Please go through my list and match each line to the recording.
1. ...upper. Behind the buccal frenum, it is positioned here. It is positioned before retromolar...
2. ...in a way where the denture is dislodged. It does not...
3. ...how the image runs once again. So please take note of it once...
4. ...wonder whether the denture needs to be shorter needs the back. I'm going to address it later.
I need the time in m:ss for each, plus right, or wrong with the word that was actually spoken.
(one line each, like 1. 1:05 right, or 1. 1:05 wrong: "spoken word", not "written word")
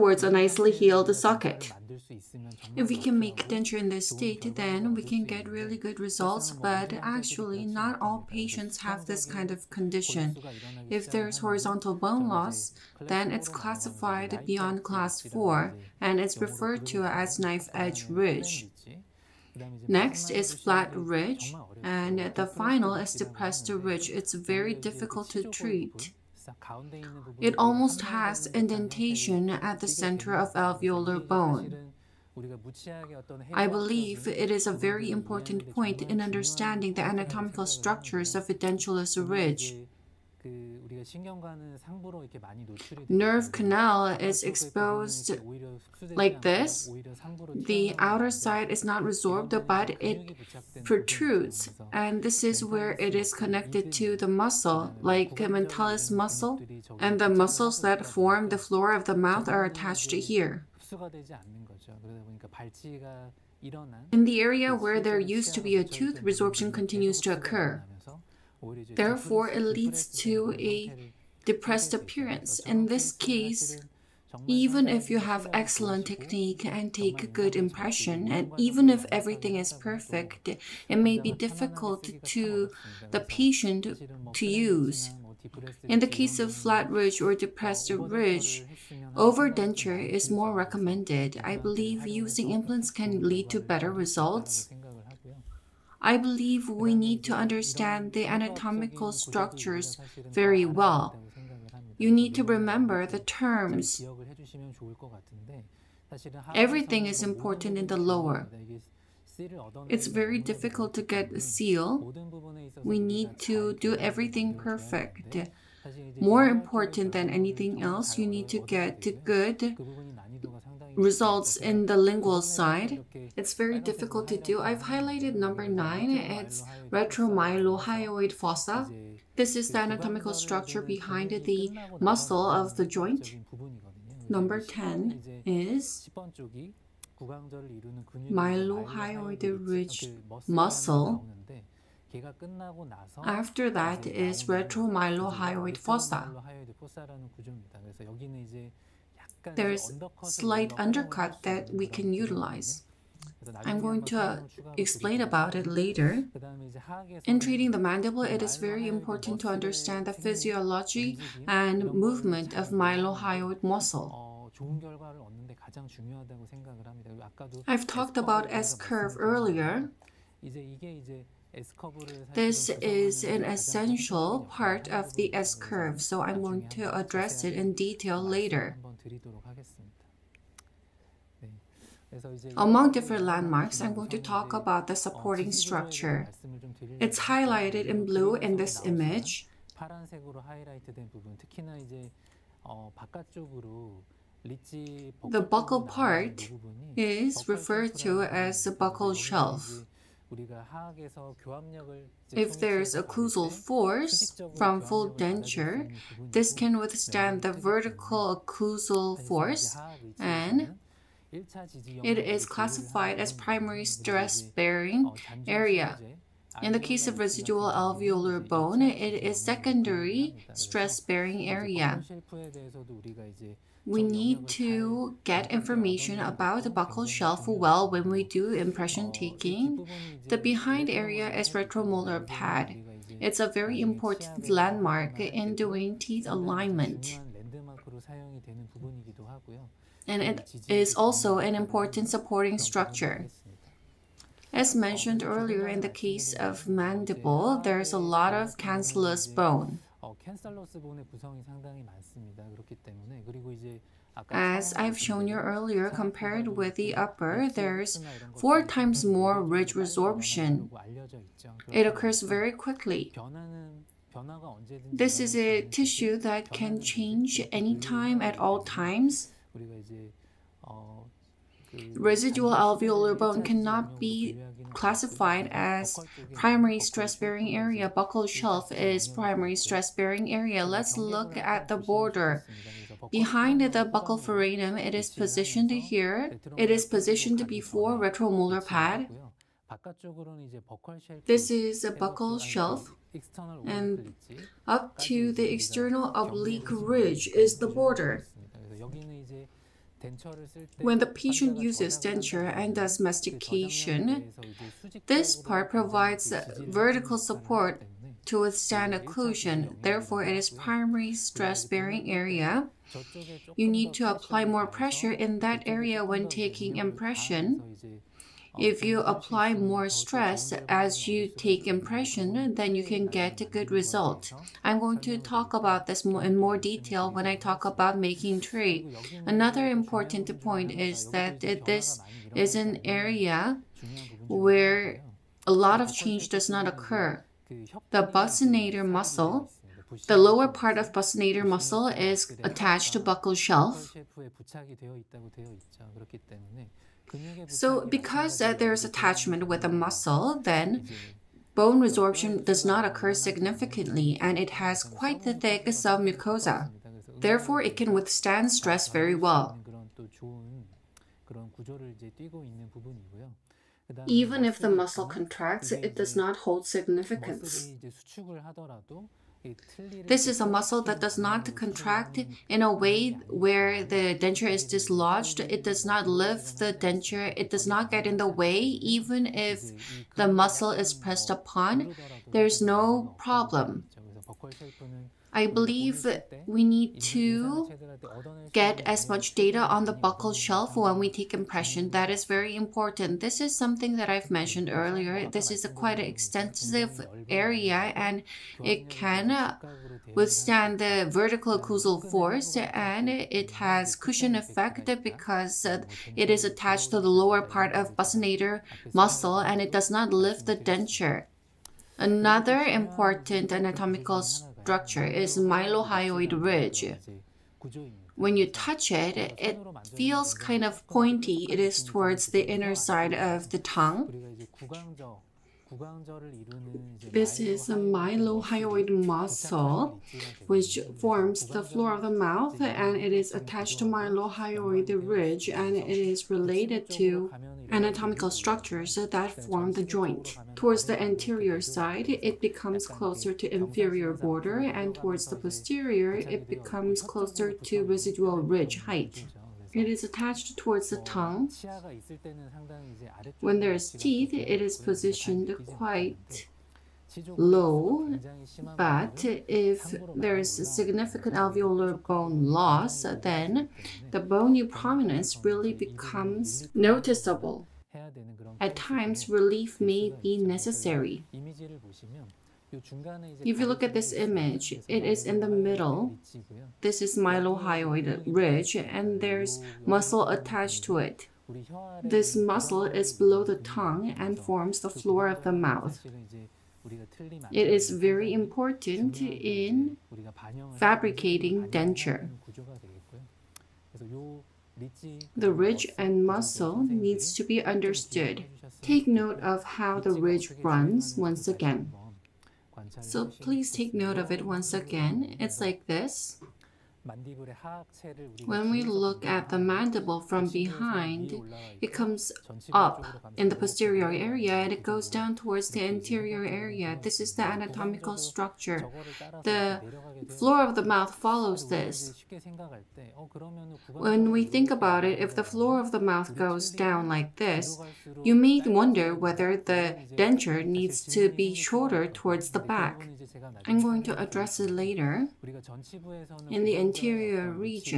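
1. 4:41 wrong: "border", not "upper"
2. 6:12 right
3. 8:19 wrong: "ridge", not "image"
4. 8:48 wrong: "towards", not "needs".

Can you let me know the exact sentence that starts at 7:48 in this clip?
At times, relief may be necessary.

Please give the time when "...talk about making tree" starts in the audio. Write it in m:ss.
5:27.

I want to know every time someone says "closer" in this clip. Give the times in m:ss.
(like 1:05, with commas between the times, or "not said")
7:22, 7:27.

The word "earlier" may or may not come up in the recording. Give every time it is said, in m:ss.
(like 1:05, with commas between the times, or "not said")
2:49, 4:05, 4:15, 6:34.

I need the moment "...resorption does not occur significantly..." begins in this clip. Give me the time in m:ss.
5:51.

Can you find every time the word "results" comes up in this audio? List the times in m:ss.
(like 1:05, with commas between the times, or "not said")
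0:05, 1:33, 2:00, 5:23.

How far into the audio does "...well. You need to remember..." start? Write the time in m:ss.
1:40.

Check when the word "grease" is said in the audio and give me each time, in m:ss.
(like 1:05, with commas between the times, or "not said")
not said.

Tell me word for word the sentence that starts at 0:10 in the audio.
If there's horizontal bone loss, then it's classified beyond class 4 and it's referred to as knife edge ridge.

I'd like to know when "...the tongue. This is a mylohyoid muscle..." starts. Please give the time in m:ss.
7:03.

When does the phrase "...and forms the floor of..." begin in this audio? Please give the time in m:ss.
8:04.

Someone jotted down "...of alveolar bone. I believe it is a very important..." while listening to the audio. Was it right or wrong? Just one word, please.
right.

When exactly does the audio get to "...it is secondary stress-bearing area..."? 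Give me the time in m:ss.
3:38.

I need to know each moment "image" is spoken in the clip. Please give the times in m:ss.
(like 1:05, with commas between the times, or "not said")
3:08, 7:54.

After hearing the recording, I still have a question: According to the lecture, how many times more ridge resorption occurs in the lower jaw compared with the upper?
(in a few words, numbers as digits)
4.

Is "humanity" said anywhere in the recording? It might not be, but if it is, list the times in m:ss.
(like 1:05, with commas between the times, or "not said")
not said.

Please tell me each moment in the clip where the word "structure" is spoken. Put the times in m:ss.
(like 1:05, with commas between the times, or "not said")
0:37, 1:39, 2:10, 3:05, 4:02, 6:54, 7:18, 8:38.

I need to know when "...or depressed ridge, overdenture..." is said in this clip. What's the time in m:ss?
1:27.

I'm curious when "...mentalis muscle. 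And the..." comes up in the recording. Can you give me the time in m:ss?
0:55.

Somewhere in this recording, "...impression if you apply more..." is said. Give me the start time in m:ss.
5:16.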